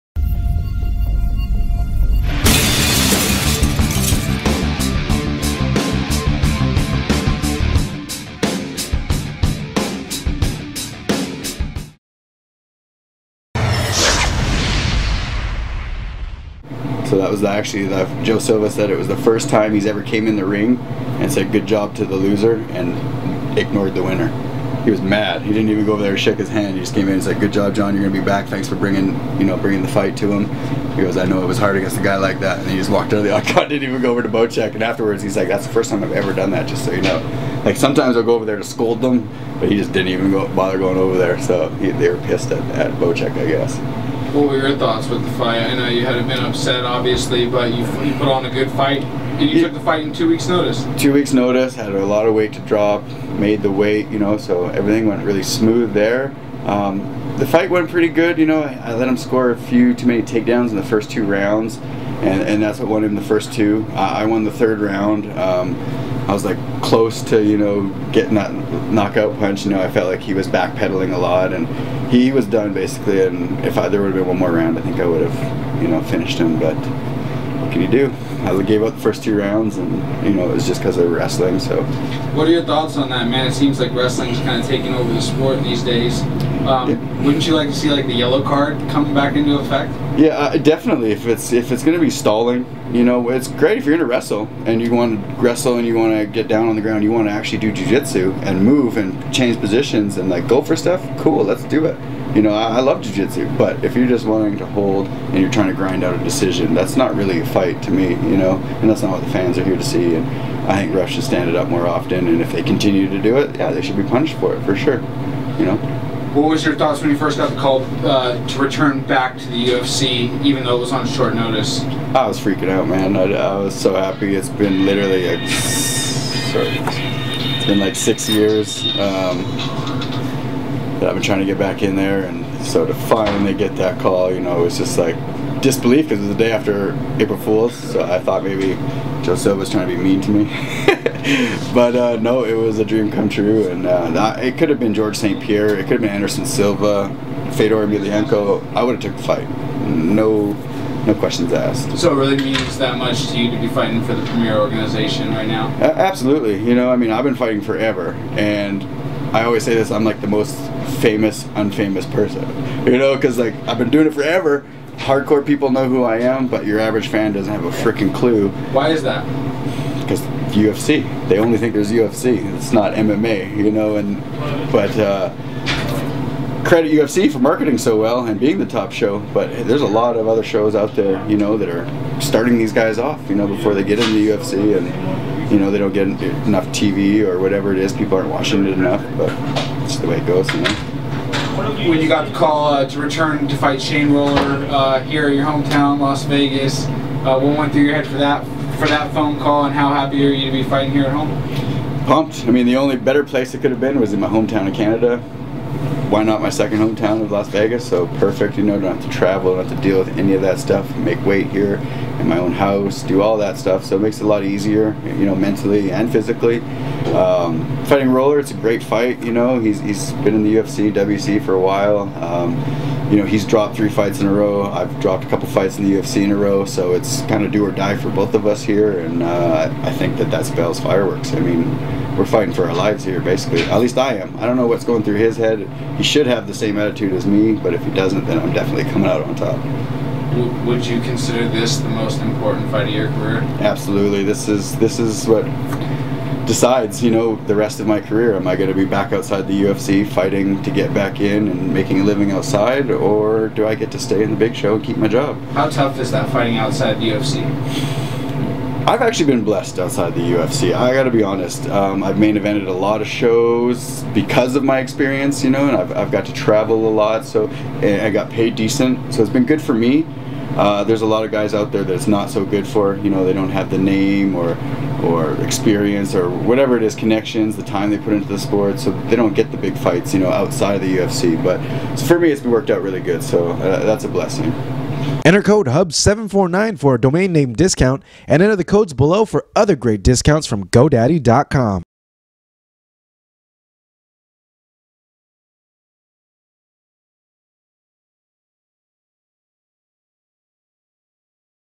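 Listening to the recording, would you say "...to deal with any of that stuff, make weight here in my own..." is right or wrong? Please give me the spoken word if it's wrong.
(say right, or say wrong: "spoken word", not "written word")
right.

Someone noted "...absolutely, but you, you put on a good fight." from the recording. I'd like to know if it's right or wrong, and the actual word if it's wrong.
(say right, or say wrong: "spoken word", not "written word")
wrong: "obviously", not "absolutely".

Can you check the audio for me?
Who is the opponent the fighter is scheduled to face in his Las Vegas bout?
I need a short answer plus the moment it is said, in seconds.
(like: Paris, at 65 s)
Shane Roller, at 193 s.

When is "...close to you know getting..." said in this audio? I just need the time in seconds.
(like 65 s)
66 s.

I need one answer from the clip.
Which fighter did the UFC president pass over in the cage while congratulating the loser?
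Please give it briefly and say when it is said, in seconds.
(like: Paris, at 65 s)
Bocek, at 34 s.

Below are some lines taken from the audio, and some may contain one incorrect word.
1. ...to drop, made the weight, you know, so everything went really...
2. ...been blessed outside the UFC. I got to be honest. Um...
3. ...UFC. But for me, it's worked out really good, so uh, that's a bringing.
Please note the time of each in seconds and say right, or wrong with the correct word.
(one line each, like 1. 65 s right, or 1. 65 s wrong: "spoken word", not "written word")
1. 52 s right
2. 259 s right
3. 280 s wrong: "blessing", not "bringing".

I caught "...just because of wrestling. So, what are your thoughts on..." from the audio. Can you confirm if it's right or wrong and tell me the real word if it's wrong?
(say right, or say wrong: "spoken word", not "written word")
right.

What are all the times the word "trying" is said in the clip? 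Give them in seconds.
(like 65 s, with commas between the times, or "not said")
105 s, 131 s, 139 s.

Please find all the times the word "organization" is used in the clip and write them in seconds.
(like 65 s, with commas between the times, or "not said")
154 s.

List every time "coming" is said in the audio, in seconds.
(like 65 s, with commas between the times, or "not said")
88 s, 238 s.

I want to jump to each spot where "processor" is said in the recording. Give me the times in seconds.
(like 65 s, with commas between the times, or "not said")
not said.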